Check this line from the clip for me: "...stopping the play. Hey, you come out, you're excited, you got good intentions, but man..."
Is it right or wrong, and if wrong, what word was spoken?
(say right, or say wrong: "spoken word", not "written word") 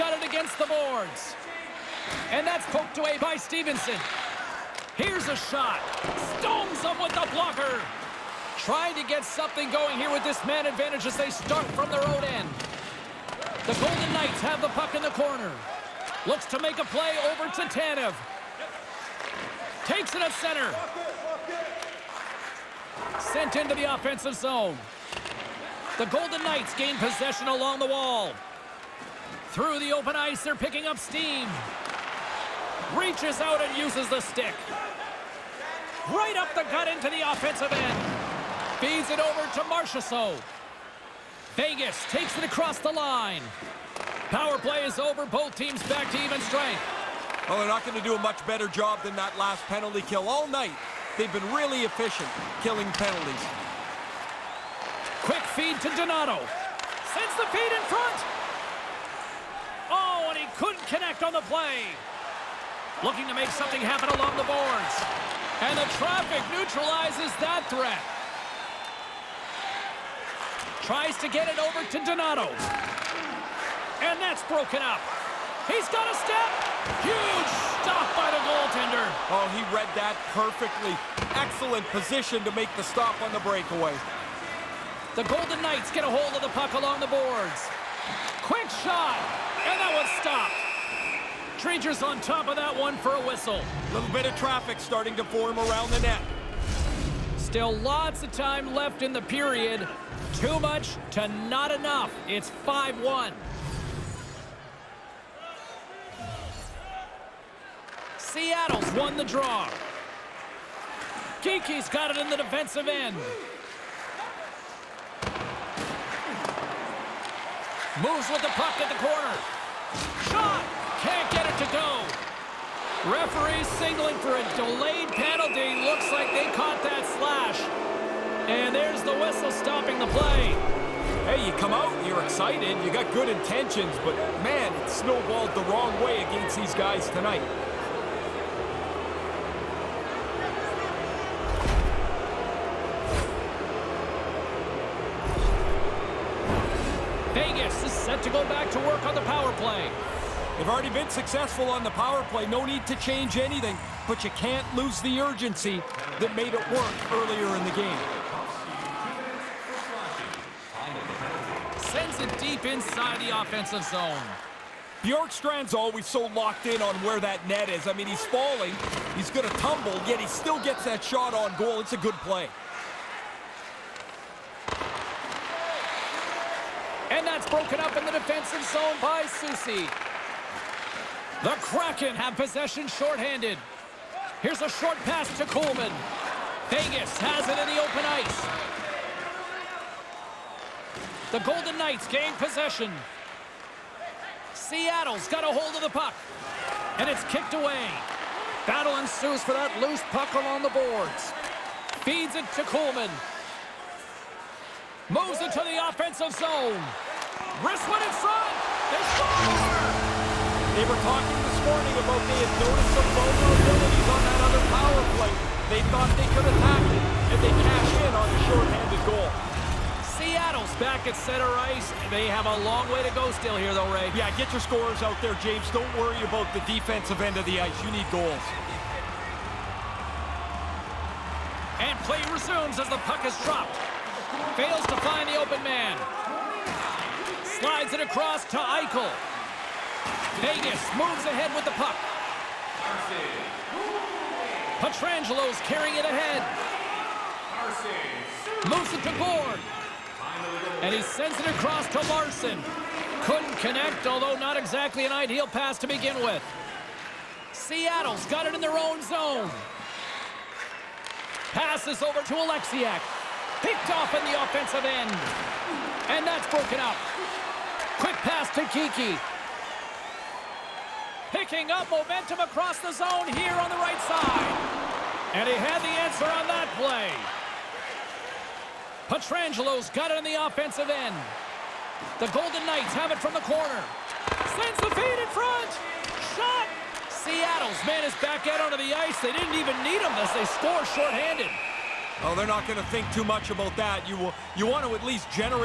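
right.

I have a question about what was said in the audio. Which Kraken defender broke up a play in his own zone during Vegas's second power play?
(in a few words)
Soucy.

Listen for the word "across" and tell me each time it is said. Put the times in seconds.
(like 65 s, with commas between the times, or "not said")
42 s, 237 s, 251 s, 272 s.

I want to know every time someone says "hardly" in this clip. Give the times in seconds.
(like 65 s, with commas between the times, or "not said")
not said.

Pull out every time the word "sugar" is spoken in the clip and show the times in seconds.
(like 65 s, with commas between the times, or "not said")
not said.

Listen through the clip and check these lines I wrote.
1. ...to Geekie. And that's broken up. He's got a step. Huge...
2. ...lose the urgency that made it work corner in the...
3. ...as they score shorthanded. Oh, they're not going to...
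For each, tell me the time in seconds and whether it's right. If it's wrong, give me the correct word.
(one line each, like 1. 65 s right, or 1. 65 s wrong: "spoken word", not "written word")
1. 71 s wrong: "Donato", not "Geekie"
2. 154 s wrong: "earlier", not "corner"
3. 290 s right.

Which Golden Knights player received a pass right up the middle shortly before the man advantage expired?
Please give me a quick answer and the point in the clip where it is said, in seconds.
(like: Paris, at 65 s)
Marchessault, at 39 s.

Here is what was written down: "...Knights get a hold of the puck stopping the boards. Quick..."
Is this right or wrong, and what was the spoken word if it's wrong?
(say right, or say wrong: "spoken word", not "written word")
wrong: "along", not "stopping".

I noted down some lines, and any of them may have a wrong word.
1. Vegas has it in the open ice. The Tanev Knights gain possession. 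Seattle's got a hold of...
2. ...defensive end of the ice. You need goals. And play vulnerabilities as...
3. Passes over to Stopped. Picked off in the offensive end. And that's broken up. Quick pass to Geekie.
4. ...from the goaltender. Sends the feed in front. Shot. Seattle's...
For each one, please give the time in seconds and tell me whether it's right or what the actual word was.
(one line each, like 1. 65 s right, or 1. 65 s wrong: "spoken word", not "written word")
1. 186 s wrong: "Golden", not "Tanev"
2. 226 s wrong: "resumes", not "vulnerabilities"
3. 261 s wrong: "Oleksiak", not "Stopped"
4. 283 s wrong: "corner", not "goaltender".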